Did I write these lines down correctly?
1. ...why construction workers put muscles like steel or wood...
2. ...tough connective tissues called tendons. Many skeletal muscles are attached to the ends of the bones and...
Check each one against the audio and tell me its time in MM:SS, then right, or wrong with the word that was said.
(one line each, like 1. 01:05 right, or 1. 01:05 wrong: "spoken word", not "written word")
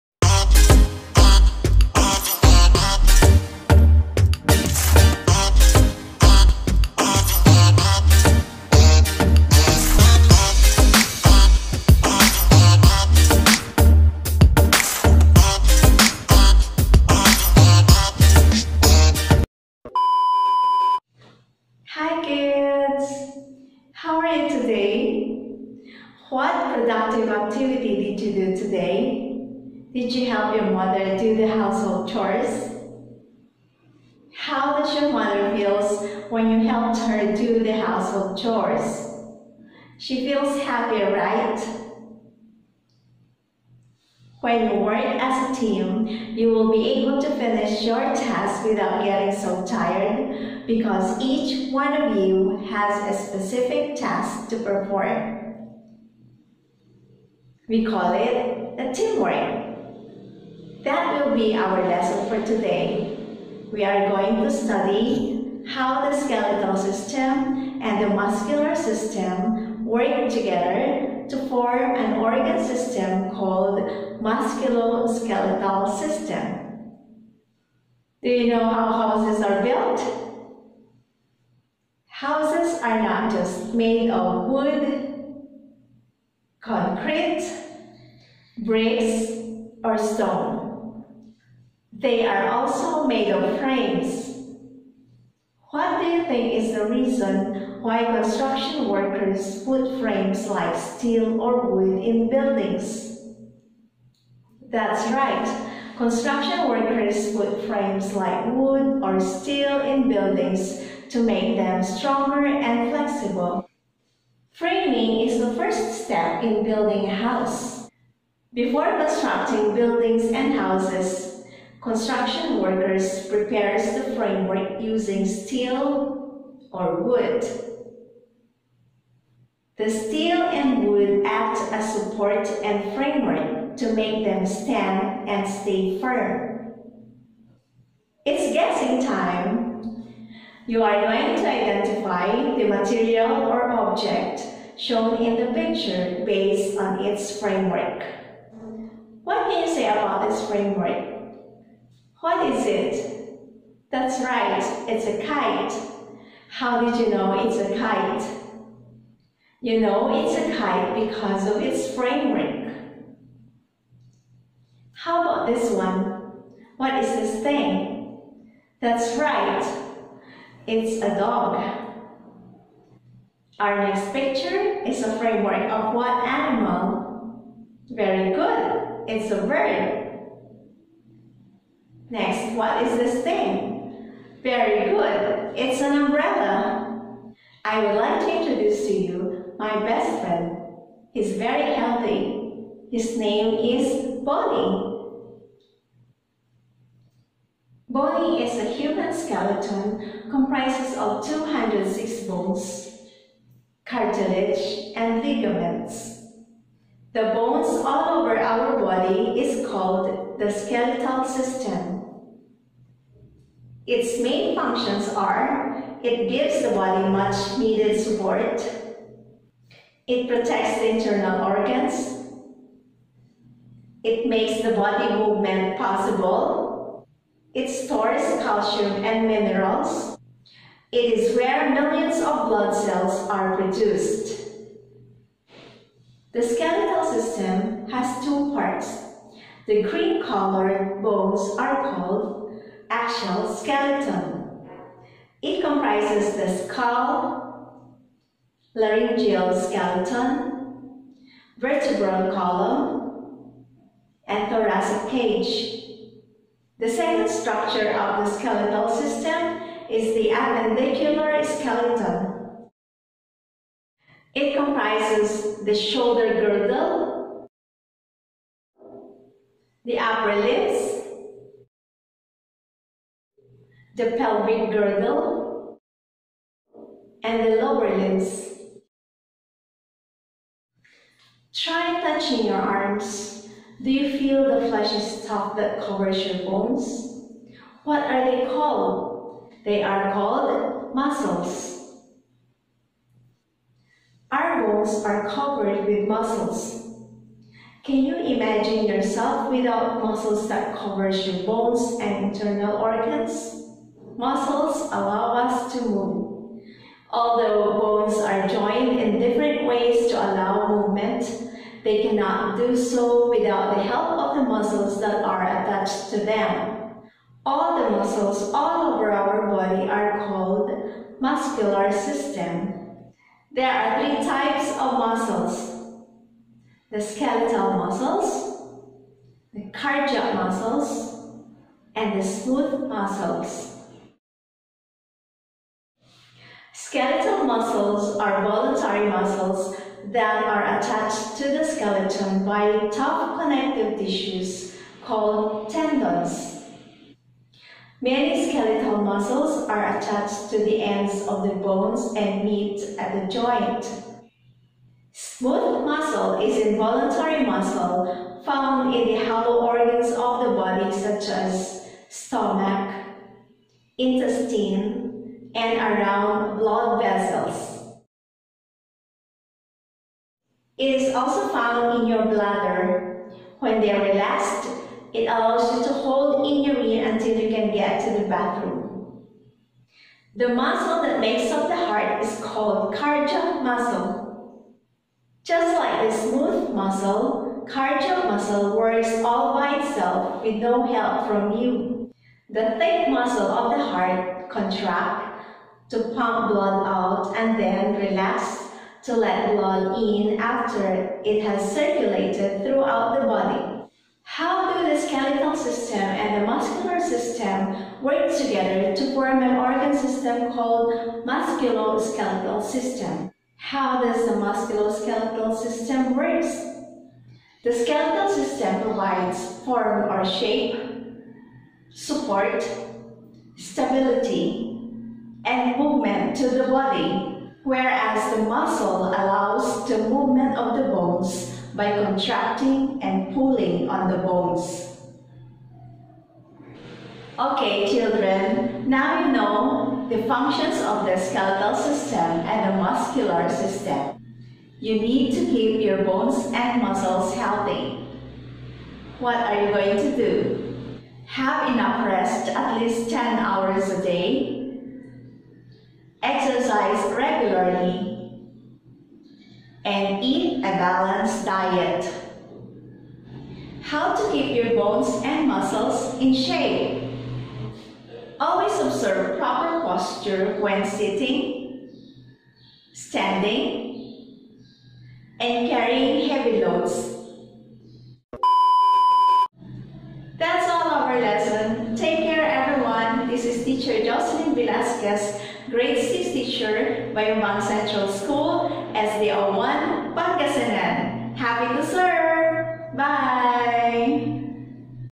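1. 01:37 wrong: "frames", not "muscles"
2. 05:42 right.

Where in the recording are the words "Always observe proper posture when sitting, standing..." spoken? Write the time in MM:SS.
07:48.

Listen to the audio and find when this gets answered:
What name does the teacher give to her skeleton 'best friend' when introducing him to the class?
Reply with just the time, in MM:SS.
03:14.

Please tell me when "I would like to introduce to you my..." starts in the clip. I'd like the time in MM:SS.
03:07.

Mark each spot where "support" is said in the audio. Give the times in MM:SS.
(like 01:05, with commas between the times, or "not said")
02:11, 03:37, 07:01.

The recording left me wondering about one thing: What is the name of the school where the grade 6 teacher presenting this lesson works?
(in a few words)
Bayambang Central School.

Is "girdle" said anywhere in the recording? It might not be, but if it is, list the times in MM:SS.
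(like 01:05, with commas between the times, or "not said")
04:26, 04:34.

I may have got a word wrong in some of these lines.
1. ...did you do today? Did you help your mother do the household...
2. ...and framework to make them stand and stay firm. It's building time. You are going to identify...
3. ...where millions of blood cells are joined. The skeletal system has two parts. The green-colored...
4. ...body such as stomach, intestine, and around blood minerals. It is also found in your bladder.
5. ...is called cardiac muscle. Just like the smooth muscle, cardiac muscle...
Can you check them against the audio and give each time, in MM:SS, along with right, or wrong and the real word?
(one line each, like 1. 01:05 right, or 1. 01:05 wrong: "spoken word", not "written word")
1. 00:28 right
2. 02:12 wrong: "guessing", not "building"
3. 03:51 wrong: "produced", not "joined"
4. 06:00 wrong: "vessels", not "minerals"
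5. 06:22 right.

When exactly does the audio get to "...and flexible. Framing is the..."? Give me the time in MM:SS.
01:52.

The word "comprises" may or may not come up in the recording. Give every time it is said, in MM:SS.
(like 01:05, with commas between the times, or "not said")
03:20, 04:05, 04:24.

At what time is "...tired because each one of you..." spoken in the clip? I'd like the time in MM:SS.
00:49.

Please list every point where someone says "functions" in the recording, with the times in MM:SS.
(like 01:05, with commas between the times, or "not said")
03:34, 07:20.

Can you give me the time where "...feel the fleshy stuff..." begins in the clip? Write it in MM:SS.
04:44.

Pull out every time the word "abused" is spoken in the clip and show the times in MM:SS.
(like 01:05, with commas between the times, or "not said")
not said.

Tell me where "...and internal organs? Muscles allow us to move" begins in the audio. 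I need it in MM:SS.
05:02.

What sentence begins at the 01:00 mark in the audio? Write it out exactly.
That will be our lesson for today.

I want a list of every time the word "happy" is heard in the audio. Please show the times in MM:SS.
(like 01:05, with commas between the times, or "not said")
00:40, 08:11.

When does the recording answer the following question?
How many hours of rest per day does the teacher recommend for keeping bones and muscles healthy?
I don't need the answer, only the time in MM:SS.
07:33.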